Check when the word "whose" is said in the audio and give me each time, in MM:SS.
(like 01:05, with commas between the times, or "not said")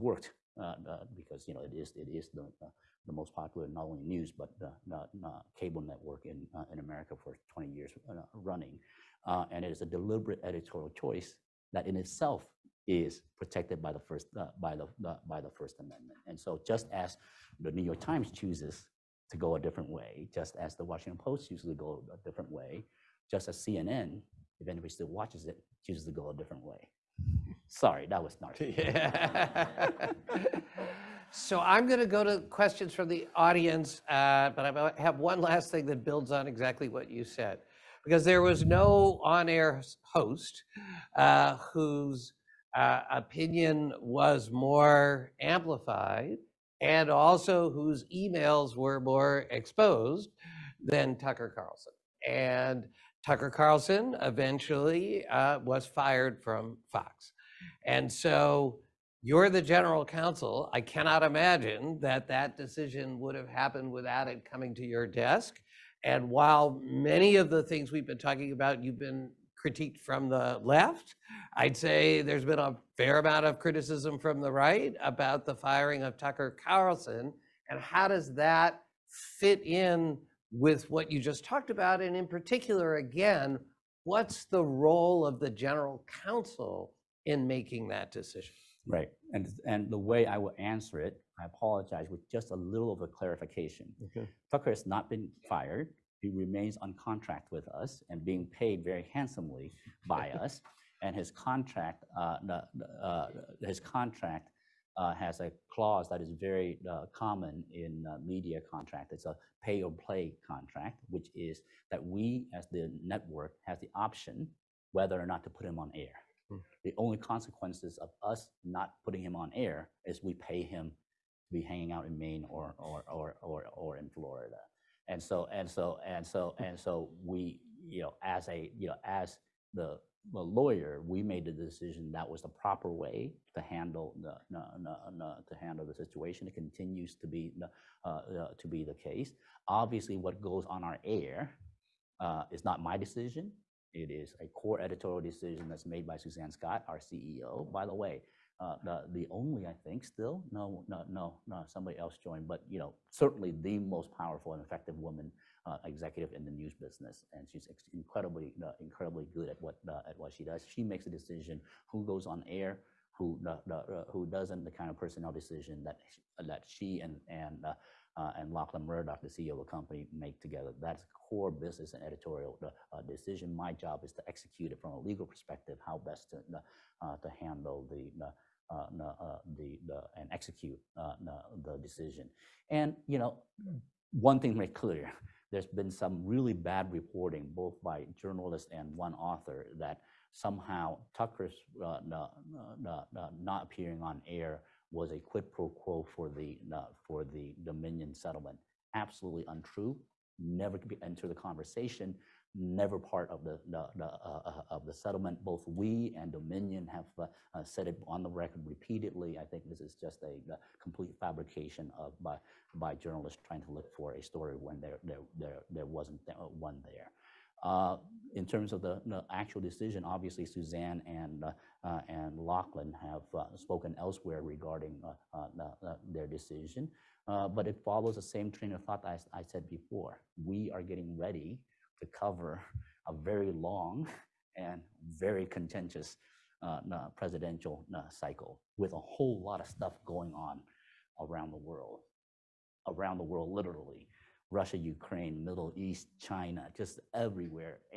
00:41, 00:47.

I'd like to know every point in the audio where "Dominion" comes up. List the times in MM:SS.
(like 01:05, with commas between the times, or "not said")
03:17, 03:26.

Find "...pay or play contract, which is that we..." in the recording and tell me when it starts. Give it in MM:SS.
01:49.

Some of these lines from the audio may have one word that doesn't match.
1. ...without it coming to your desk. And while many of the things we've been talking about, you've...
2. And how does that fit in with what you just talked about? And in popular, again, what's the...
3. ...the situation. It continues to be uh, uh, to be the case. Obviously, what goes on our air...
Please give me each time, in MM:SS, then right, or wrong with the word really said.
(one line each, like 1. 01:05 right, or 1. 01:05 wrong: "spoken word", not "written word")
1. 01:03 right
2. 01:17 wrong: "particular", not "popular"
3. 02:15 right.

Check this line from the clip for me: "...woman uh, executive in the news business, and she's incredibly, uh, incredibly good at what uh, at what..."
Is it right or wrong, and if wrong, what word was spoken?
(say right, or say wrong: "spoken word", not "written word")
right.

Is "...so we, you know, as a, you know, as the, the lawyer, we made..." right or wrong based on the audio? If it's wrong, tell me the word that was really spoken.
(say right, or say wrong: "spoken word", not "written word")
right.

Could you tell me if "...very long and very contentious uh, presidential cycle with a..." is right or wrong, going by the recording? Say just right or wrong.
right.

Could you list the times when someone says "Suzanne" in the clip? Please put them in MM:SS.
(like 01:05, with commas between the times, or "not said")
02:26, 03:40.